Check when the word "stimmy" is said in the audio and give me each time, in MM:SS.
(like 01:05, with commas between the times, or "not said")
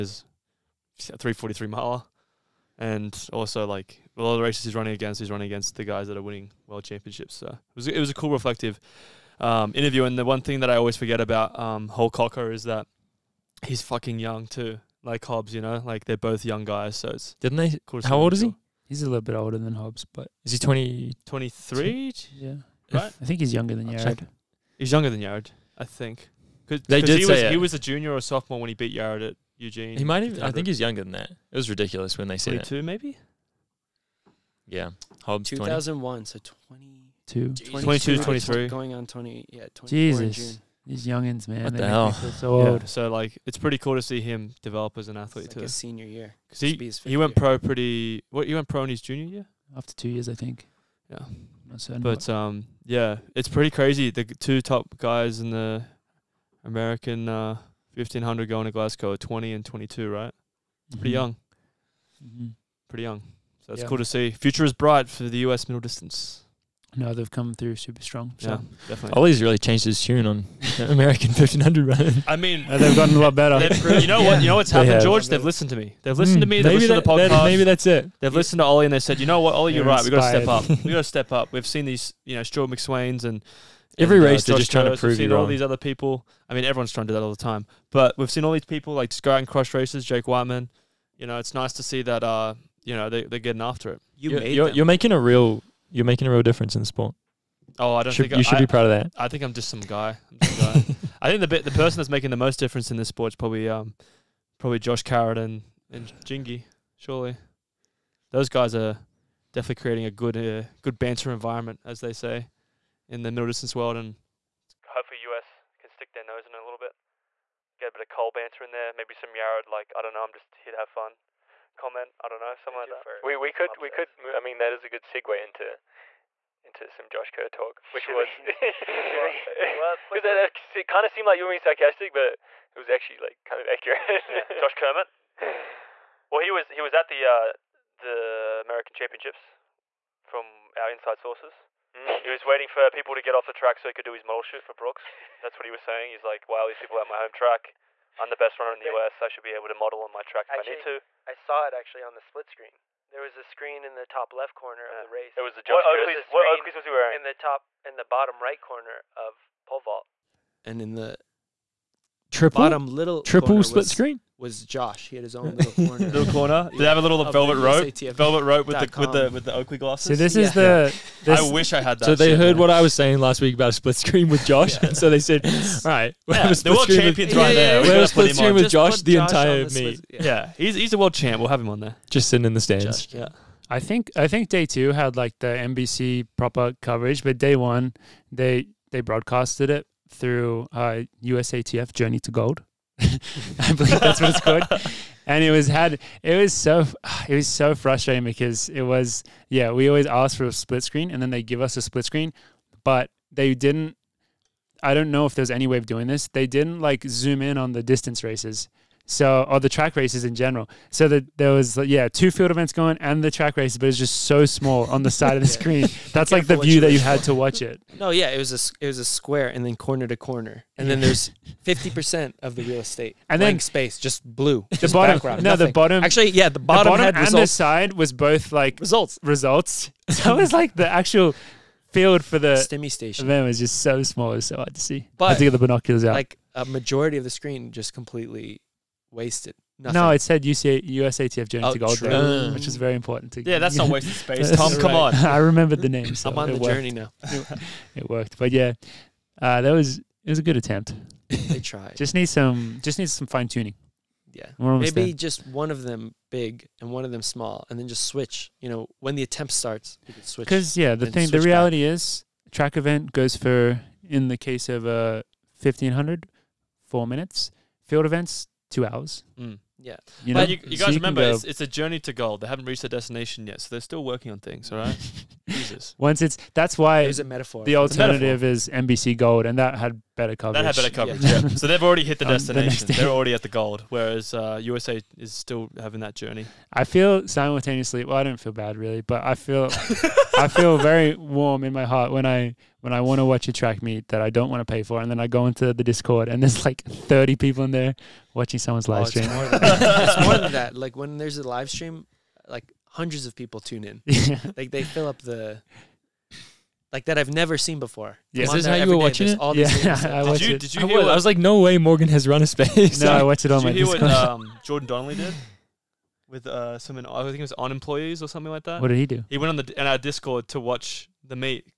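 03:52.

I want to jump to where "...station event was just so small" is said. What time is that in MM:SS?
03:52.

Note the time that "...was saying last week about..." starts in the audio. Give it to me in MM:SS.
02:52.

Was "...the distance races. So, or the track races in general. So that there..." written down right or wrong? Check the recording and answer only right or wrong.
right.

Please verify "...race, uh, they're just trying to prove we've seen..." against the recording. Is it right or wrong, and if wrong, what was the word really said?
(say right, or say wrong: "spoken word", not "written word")
right.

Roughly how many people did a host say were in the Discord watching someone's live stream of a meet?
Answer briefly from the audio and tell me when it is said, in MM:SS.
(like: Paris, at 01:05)
30, at 04:56.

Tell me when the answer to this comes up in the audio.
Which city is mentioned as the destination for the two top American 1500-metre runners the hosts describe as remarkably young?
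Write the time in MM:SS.
00:58.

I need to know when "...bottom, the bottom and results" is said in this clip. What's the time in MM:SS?
03:46.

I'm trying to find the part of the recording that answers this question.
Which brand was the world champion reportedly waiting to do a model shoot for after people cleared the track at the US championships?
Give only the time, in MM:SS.
02:24.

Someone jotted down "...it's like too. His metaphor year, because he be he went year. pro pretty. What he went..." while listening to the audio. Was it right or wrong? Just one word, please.
wrong.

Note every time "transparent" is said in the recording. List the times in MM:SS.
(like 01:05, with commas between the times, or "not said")
not said.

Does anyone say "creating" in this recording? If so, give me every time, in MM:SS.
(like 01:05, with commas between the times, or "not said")
01:49.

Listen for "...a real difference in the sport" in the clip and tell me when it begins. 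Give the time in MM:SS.
01:36.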